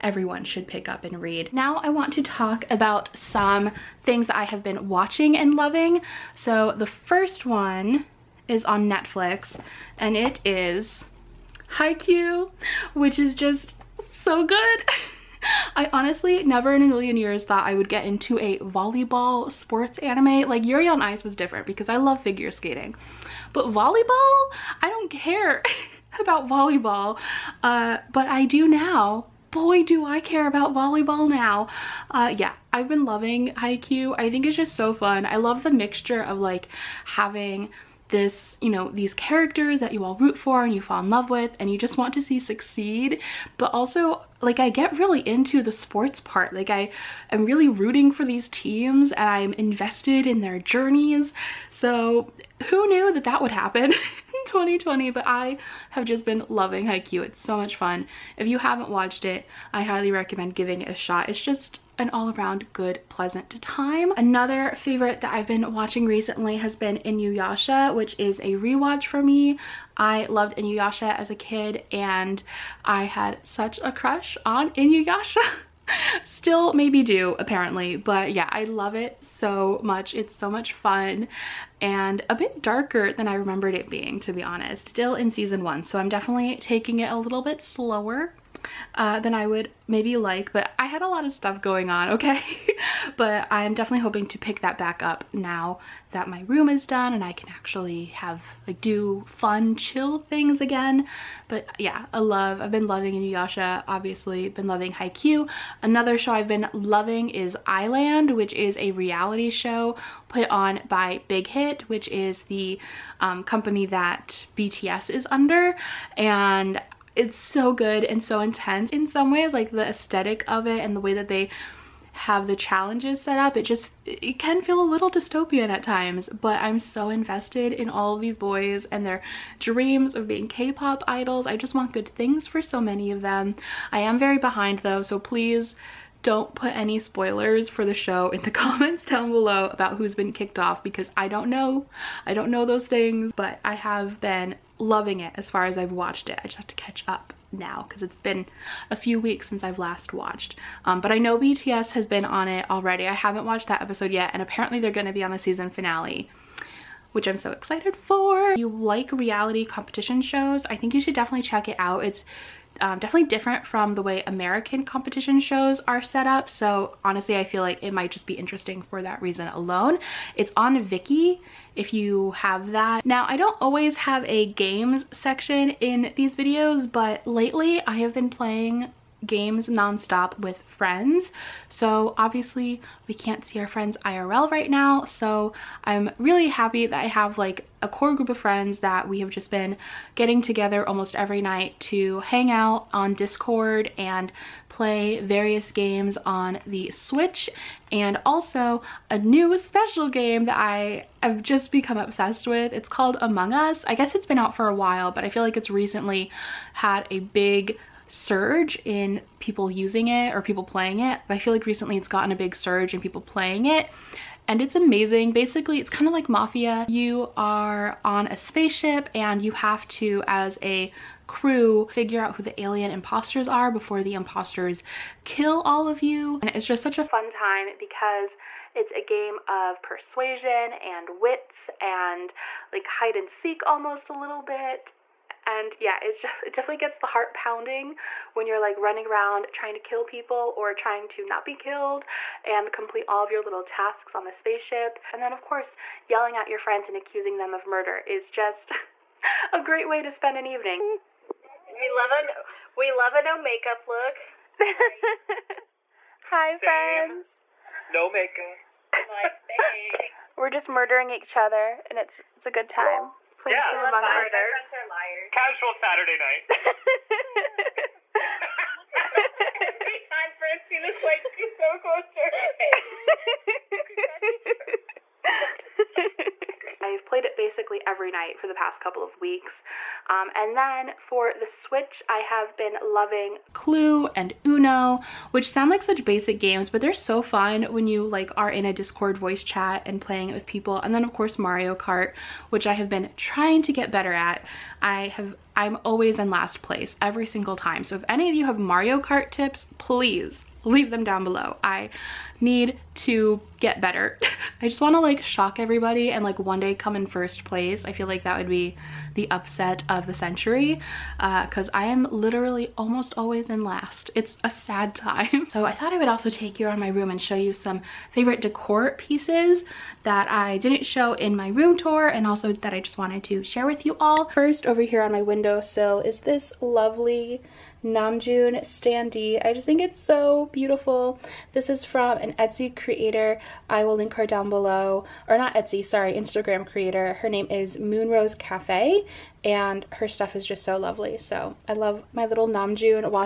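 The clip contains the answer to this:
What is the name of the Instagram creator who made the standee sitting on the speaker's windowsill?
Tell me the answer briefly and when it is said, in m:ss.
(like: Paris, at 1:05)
Moonrose Cafe, at 5:37.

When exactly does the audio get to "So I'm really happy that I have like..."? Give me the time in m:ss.
3:05.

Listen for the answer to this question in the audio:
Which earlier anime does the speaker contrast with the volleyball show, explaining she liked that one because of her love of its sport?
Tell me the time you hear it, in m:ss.
0:20.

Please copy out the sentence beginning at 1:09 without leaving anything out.
I loved Inuyasha as a kid and I had such a crush on Inuyasha.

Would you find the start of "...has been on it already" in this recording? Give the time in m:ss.
2:31.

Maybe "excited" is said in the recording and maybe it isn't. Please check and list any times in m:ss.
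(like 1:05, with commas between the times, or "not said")
2:37.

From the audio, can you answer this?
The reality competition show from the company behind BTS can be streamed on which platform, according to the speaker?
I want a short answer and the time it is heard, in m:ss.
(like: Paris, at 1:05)
Viki, at 2:50.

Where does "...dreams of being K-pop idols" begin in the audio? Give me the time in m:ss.
2:09.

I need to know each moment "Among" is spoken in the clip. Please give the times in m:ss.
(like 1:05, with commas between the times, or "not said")
3:23, 4:23.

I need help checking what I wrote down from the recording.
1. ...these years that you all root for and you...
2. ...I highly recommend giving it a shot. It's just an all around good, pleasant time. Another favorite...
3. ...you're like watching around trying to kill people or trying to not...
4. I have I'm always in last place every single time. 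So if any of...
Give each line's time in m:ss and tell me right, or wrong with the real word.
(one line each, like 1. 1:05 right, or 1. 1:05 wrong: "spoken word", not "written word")
1. 0:38 wrong: "characters", not "years"
2. 0:59 right
3. 3:58 wrong: "running", not "watching"
4. 4:54 right.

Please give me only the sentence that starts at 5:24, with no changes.
First over here on my windowsill is this lovely Namjoon standee.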